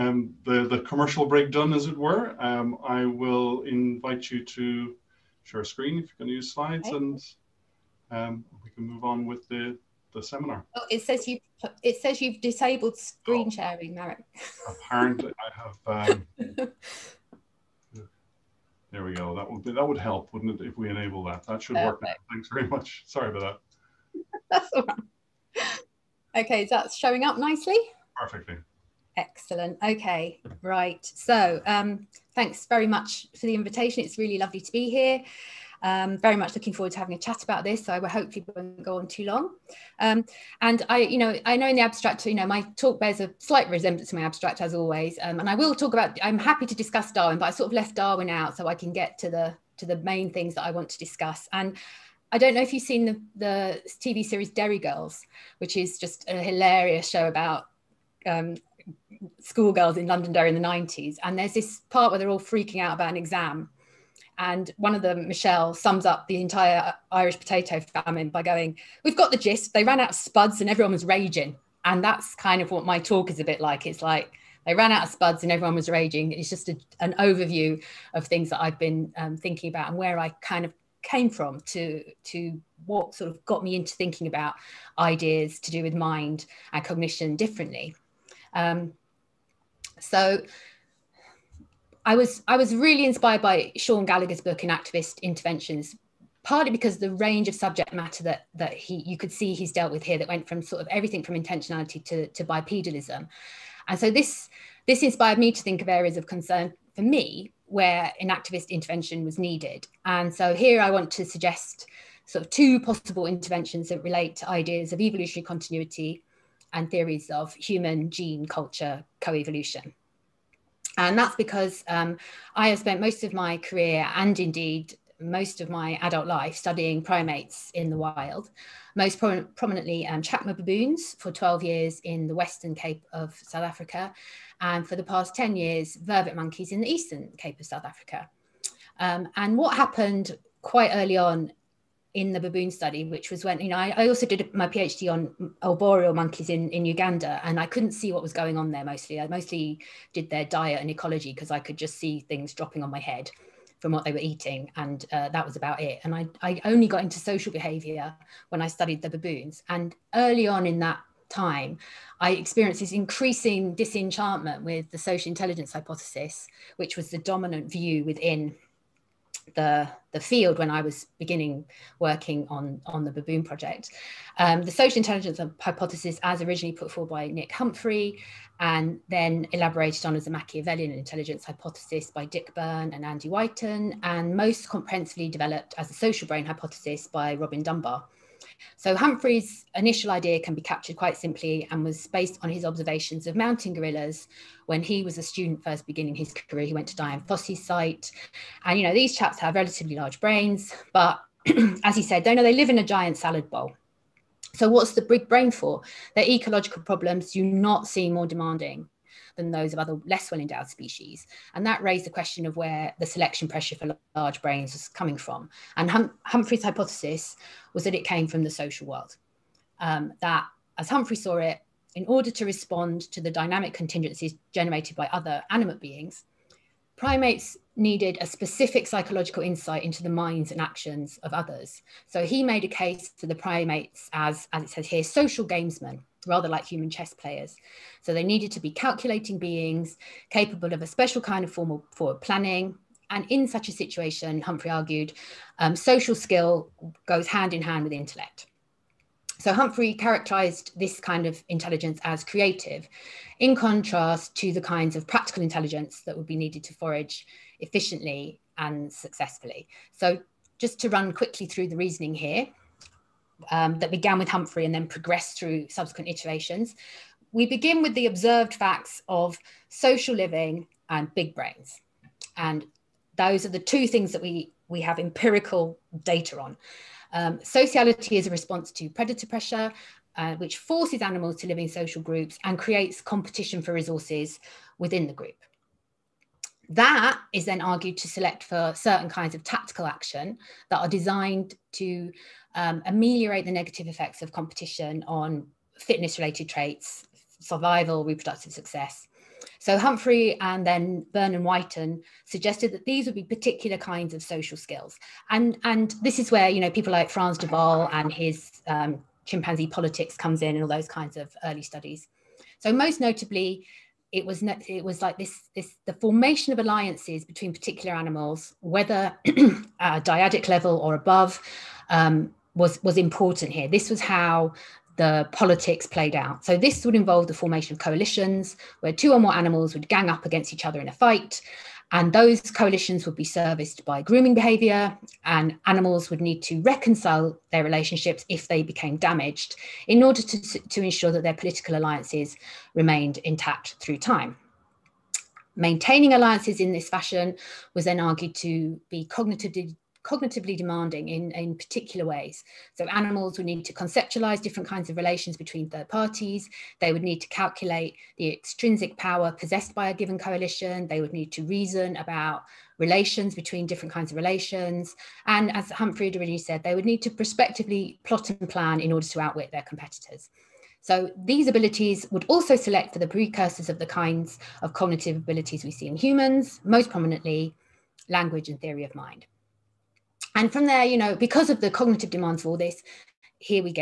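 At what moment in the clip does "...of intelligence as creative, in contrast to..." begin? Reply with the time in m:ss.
4:11.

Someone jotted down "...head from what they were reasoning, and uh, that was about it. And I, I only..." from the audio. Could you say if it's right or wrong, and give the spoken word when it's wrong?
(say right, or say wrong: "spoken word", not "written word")
wrong: "eating", not "reasoning".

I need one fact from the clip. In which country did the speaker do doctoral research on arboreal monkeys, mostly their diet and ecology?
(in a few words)
Uganda.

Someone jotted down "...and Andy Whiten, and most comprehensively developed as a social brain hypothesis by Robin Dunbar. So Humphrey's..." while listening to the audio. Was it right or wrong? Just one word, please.
right.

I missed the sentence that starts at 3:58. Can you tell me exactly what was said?
So they needed to be calculating beings capable of a special kind of formal forward planning.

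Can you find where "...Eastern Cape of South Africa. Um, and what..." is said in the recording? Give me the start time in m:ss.
2:16.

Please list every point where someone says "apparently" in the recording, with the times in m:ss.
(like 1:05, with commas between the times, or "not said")
0:14.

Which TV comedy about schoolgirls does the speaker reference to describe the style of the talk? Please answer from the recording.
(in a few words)
Derry Girls.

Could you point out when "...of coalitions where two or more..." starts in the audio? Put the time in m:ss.
5:27.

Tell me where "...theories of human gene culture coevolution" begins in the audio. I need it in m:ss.
1:56.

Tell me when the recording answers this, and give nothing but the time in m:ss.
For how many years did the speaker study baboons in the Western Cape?
2:11.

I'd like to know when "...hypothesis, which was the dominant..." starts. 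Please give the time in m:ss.
2:45.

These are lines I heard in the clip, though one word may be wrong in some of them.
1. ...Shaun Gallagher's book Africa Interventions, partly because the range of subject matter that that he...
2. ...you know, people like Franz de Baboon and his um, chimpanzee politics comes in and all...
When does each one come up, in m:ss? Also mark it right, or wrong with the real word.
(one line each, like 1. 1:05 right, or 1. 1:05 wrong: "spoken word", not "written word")
1. 1:33 wrong: "Enactivist", not "Africa"
2. 5:06 wrong: "Waal", not "Baboon".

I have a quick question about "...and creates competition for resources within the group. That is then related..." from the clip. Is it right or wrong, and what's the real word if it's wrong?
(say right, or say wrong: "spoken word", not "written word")
wrong: "argued", not "related".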